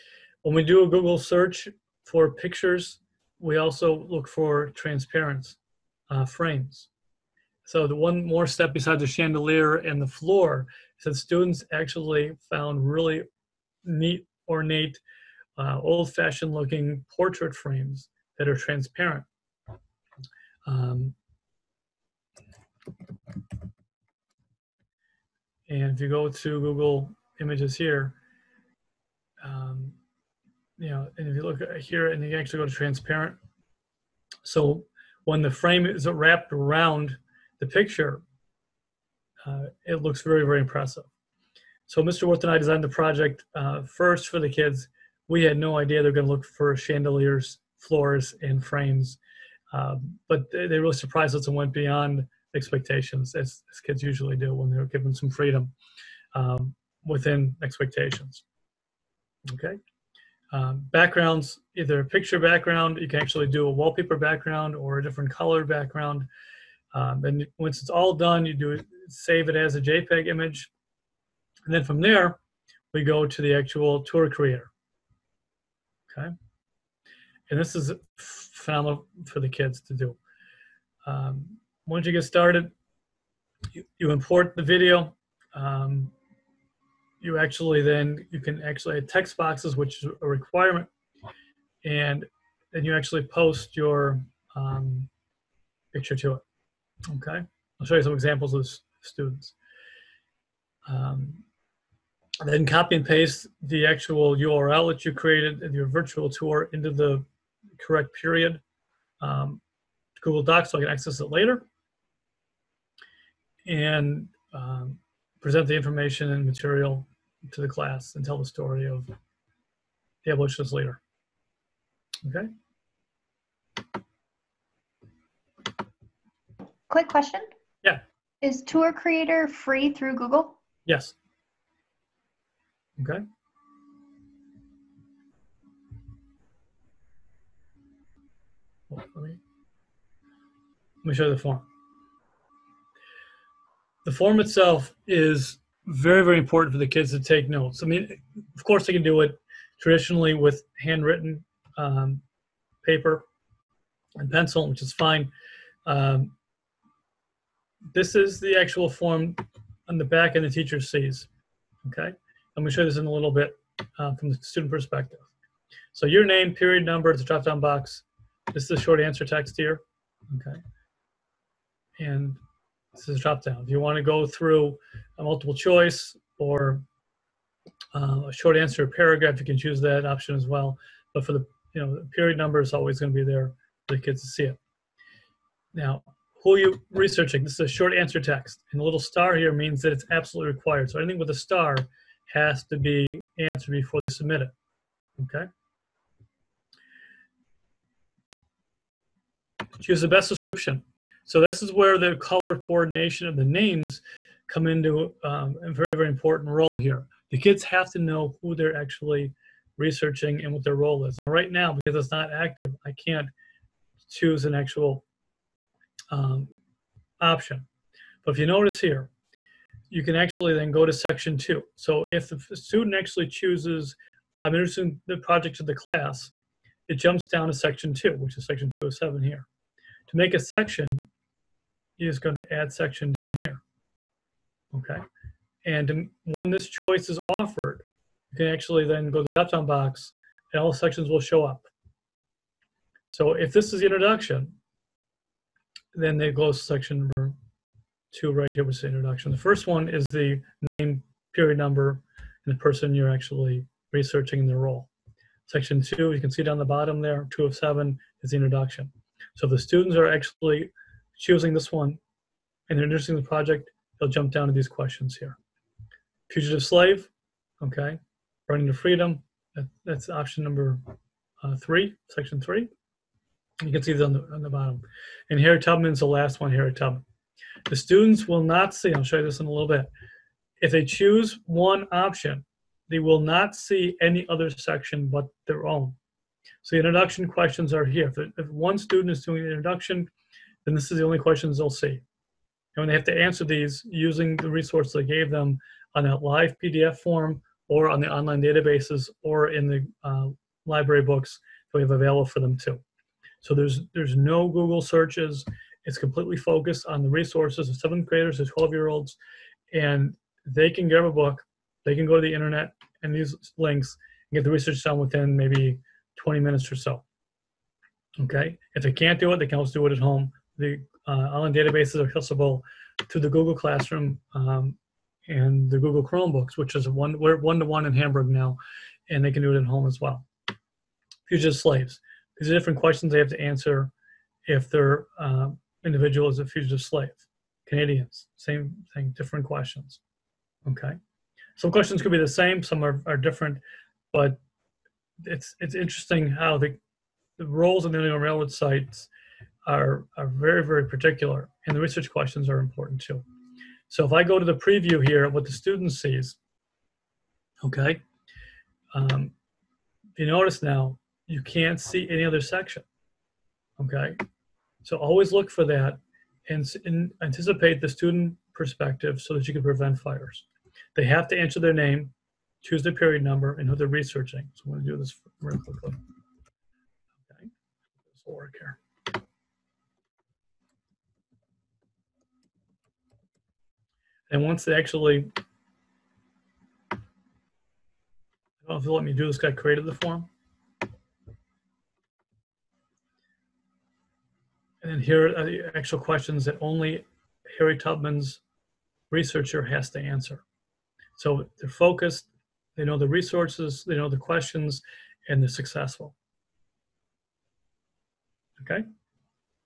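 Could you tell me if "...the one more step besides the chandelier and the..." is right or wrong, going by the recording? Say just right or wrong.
right.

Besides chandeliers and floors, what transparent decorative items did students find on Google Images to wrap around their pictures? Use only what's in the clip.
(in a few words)
Portrait frames.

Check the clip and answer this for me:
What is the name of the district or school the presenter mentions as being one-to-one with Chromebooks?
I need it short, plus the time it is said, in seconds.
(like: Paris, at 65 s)
Hamburg, at 327 s.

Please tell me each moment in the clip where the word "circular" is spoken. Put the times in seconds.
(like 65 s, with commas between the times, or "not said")
not said.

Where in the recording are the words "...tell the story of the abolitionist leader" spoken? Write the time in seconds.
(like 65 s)
118 s.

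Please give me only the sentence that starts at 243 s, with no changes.
So if this is the introduction, then they go to section number two right here, with the introduction.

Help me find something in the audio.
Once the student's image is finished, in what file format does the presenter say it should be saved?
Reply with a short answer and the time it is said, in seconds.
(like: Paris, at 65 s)
JPEG, at 69 s.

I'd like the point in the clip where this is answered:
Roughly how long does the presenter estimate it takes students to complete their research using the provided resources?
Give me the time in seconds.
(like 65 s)
316 s.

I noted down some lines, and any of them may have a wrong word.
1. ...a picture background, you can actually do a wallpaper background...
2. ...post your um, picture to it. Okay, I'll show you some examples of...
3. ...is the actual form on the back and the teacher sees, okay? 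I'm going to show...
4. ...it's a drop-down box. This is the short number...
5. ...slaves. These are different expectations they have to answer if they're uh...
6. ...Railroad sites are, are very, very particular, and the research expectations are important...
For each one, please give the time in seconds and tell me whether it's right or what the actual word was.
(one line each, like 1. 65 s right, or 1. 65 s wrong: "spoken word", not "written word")
1. 62 s right
2. 93 s right
3. 158 s right
4. 167 s wrong: "answer", not "number"
5. 331 s wrong: "questions", not "expectations"
6. 348 s wrong: "questions", not "expectations".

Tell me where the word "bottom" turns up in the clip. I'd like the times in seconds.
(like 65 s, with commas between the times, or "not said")
256 s, 274 s.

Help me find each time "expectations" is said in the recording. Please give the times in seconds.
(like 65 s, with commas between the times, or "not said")
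52 s, 57 s.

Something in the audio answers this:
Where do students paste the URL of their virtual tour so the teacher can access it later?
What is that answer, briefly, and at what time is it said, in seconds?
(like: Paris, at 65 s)
Google Docs, at 110 s.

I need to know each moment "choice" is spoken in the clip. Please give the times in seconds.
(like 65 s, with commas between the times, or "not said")
175 s, 236 s.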